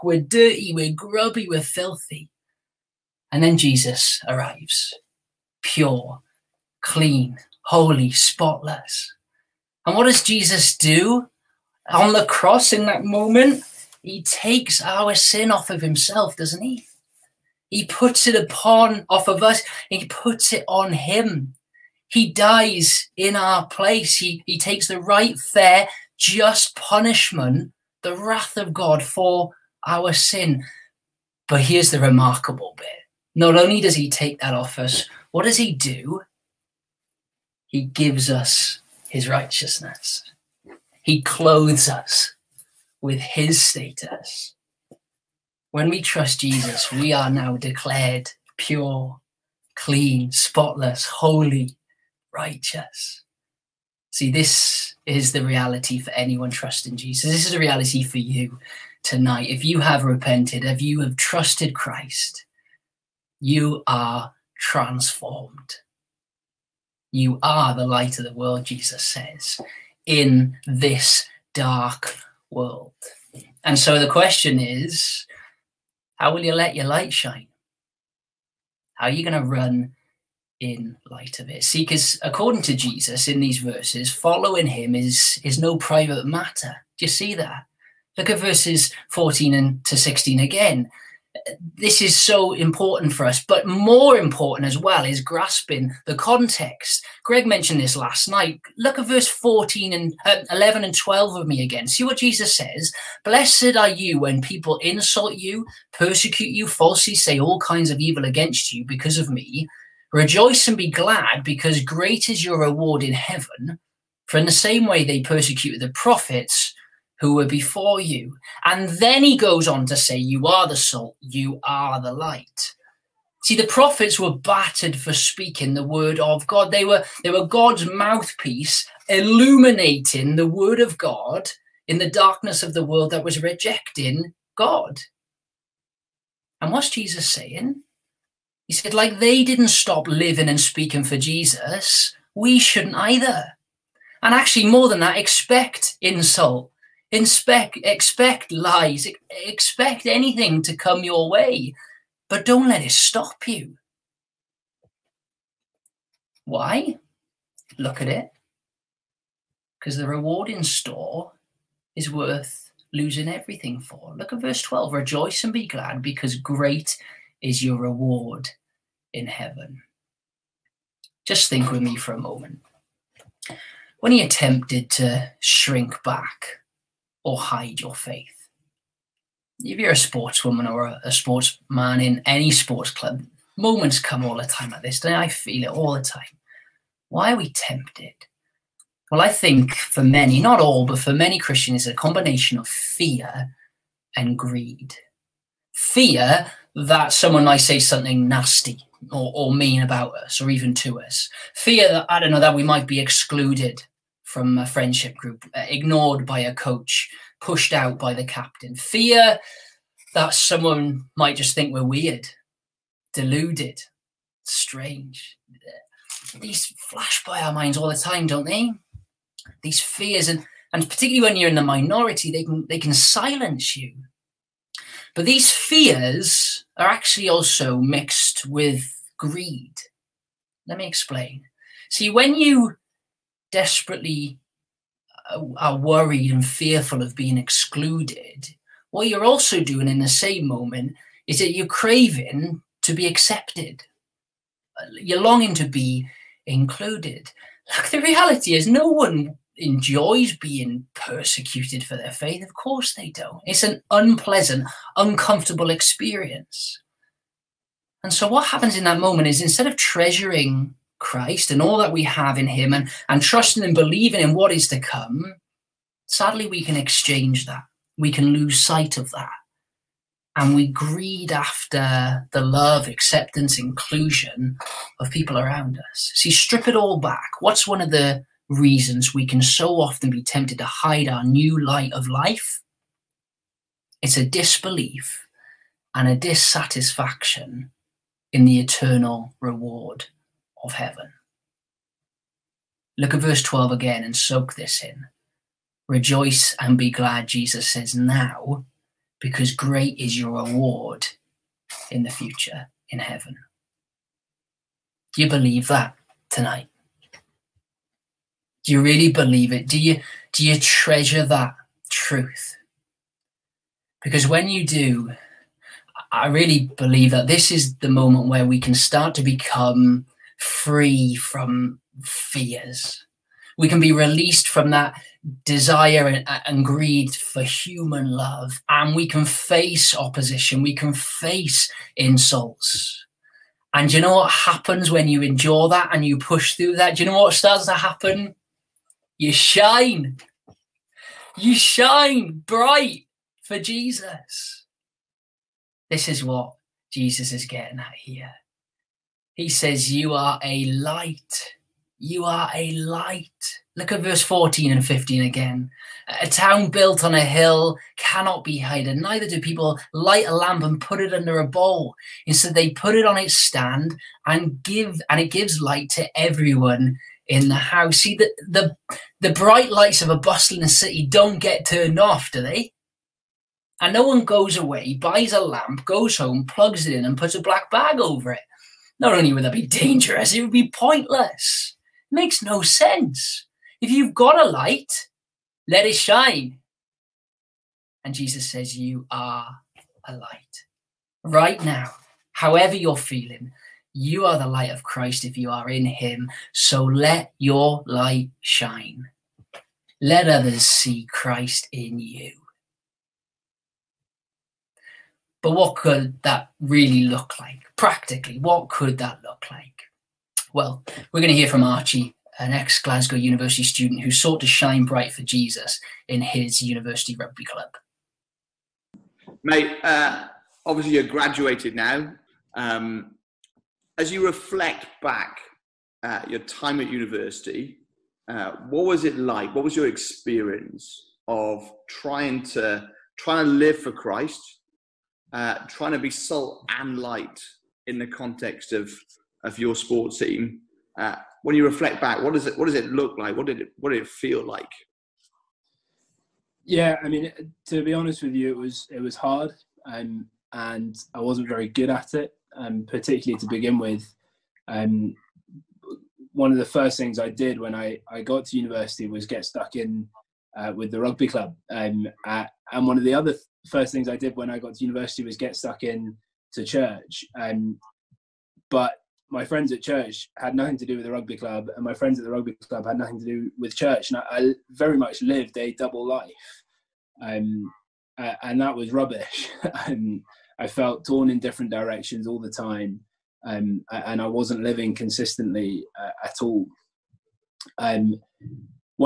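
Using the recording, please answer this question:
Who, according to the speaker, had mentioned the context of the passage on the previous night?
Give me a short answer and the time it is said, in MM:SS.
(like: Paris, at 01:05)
Greg, at 01:37.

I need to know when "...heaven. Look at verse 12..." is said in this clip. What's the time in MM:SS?
04:50.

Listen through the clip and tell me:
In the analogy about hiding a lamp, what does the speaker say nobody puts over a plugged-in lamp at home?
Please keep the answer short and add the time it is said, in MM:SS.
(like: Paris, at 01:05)
a black bag, at 06:17.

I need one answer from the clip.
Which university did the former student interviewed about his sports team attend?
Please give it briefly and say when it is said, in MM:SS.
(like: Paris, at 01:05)
Glasgow University, at 06:52.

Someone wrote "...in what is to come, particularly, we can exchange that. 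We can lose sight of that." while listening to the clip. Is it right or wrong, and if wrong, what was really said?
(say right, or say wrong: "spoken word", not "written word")
wrong: "sadly", not "particularly".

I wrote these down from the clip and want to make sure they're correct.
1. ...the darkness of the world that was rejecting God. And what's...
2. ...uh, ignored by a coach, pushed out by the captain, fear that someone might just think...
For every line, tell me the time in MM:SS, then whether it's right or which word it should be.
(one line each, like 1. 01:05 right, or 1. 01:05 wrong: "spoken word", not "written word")
1. 02:11 right
2. 03:25 right.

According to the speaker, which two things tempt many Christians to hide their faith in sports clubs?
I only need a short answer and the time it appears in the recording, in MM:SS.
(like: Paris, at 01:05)
fear and greed, at 03:12.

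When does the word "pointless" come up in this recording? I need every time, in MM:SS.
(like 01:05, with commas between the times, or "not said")
06:20.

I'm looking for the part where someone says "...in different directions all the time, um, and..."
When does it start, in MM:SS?
08:01.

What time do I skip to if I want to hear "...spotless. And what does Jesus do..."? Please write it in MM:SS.
00:08.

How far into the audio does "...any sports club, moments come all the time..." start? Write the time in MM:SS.
03:02.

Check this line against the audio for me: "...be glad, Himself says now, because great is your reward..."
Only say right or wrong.
wrong.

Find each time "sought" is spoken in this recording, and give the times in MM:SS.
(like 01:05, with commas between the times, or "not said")
06:54.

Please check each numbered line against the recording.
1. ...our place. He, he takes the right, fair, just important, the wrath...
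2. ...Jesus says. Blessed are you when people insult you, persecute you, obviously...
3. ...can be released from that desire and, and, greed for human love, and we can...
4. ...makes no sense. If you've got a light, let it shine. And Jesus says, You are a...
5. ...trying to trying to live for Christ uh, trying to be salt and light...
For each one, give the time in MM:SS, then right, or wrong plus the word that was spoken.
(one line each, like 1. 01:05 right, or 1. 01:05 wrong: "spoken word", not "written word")
1. 00:23 wrong: "punishment", not "important"
2. 01:42 wrong: "falsely", not "obviously"
3. 05:23 right
4. 06:22 right
5. 07:11 right.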